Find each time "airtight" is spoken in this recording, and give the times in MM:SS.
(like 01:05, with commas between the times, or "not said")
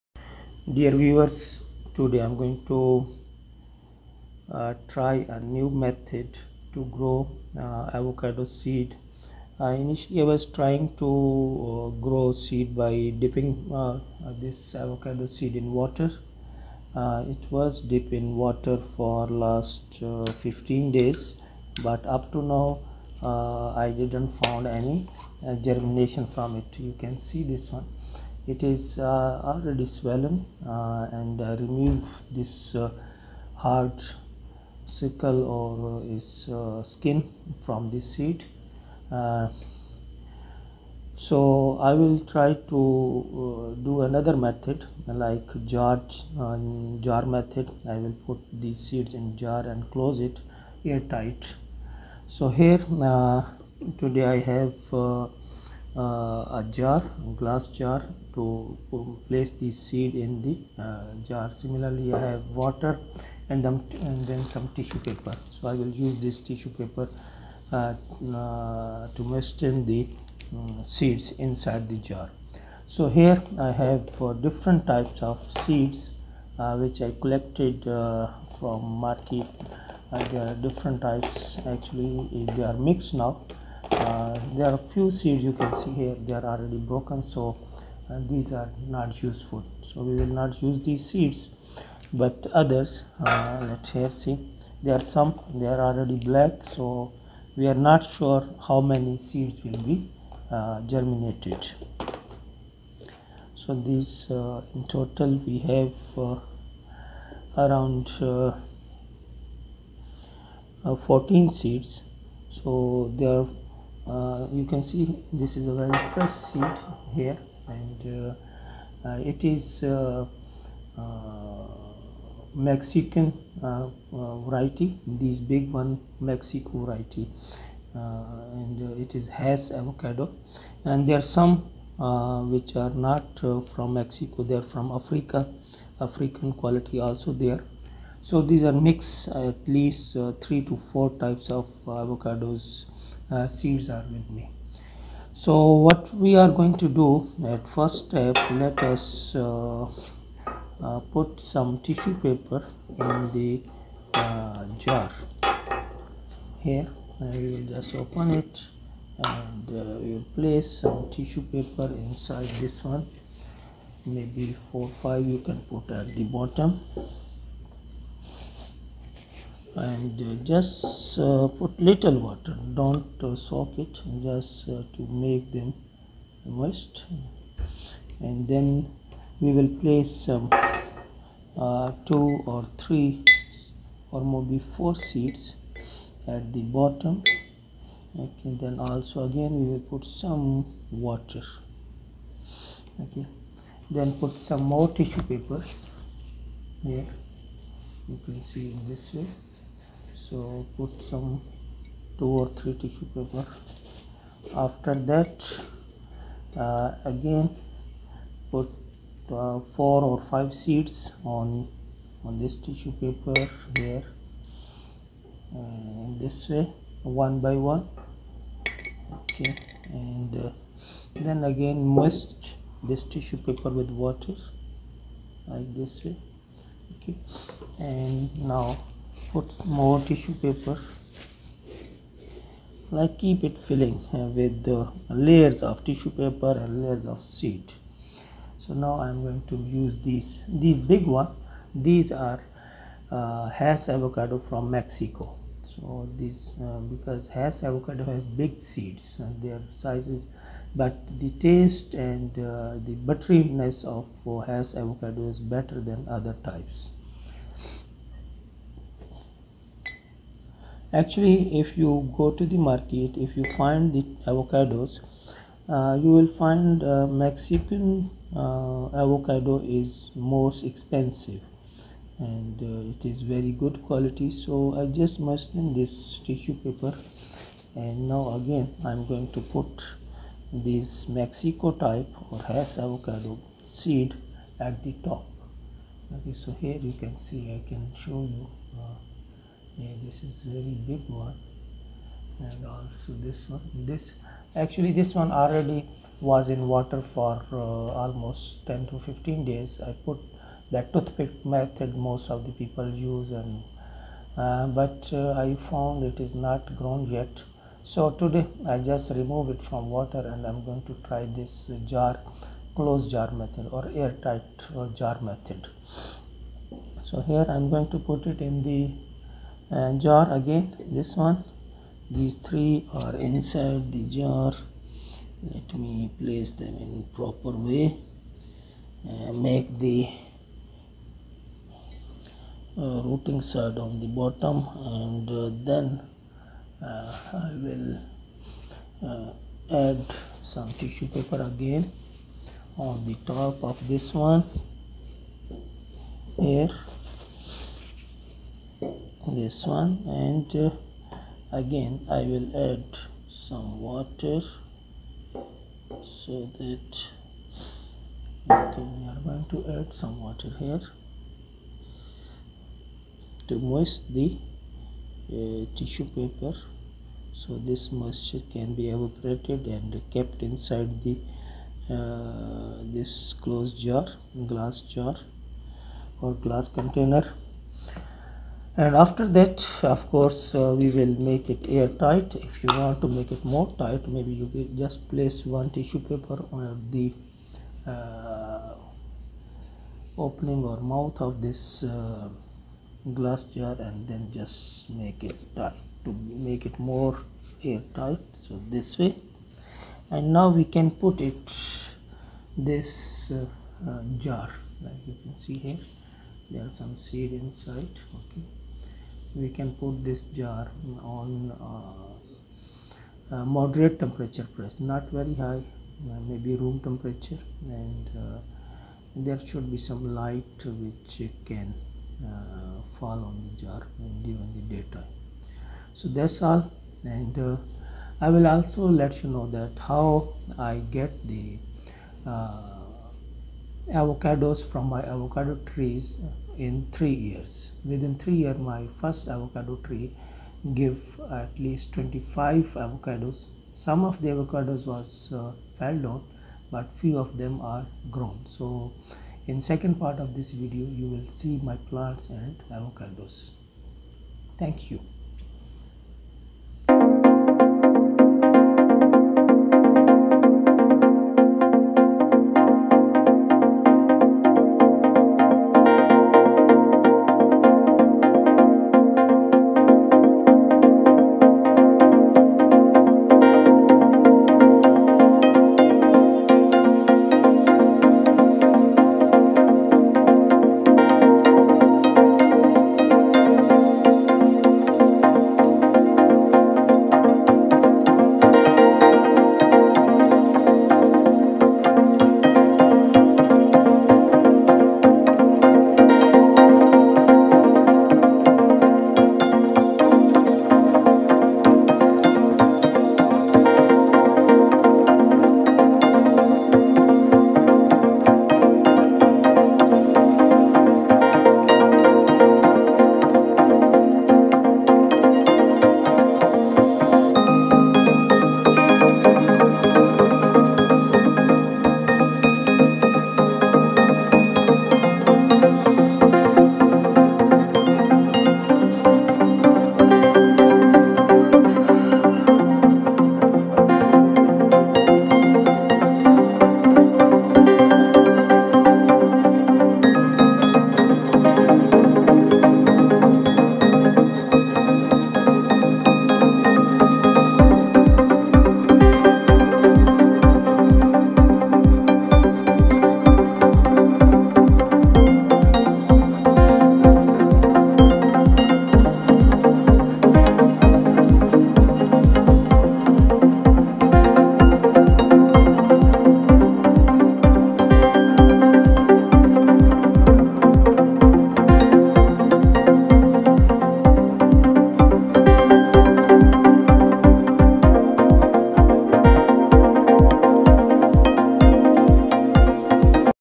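00:50, 05:14, 06:21, 06:37.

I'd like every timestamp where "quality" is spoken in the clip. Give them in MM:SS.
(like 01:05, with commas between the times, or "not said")
02:16, 04:33.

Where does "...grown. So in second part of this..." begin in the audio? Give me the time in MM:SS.
07:28.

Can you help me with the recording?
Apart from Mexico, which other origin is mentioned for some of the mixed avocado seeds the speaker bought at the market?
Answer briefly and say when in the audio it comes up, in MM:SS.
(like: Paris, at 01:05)
Africa, at 02:14.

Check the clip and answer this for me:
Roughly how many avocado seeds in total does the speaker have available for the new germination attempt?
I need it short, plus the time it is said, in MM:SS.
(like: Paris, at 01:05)
14, at 01:48.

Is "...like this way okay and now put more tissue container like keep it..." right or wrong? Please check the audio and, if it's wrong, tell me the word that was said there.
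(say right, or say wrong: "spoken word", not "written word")
wrong: "paper", not "container".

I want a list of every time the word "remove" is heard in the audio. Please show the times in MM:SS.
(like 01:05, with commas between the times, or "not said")
00:31, 05:09.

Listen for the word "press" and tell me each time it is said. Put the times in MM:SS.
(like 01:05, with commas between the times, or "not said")
06:54.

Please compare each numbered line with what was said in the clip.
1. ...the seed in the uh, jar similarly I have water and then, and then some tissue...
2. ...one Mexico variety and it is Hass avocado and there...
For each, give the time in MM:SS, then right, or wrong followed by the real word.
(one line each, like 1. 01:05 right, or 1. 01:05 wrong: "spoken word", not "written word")
1. 00:59 right
2. 02:05 right.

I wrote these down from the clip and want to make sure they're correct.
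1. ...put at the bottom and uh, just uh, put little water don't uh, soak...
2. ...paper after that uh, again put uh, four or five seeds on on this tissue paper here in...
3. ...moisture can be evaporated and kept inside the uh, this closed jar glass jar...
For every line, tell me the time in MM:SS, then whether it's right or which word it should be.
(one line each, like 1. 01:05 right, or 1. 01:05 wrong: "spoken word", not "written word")
1. 02:45 right
2. 03:23 right
3. 06:07 right.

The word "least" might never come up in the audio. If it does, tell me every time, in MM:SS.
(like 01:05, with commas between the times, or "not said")
02:19, 07:21.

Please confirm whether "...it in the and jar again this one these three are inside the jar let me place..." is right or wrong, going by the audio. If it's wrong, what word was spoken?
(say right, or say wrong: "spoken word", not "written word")
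right.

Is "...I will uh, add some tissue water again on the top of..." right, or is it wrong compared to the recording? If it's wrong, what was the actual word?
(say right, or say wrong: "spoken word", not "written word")
wrong: "paper", not "water".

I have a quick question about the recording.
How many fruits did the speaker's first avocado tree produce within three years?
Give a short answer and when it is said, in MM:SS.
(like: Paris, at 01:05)
25, at 07:21.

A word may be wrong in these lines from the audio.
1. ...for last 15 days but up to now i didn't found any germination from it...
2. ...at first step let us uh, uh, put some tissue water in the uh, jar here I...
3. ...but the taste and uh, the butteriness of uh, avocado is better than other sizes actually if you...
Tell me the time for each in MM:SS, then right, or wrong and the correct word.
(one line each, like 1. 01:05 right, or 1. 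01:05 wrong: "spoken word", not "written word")
1. 00:18 right
2. 02:27 wrong: "paper", not "water"
3. 04:10 wrong: "types", not "sizes".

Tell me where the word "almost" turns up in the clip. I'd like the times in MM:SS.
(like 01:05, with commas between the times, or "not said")
04:58.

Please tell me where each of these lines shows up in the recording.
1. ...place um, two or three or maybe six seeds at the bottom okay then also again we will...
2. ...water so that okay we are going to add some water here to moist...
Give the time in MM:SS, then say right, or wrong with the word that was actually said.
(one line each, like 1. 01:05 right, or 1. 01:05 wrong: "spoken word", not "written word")
1. 02:59 wrong: "four", not "six"
2. 05:53 right.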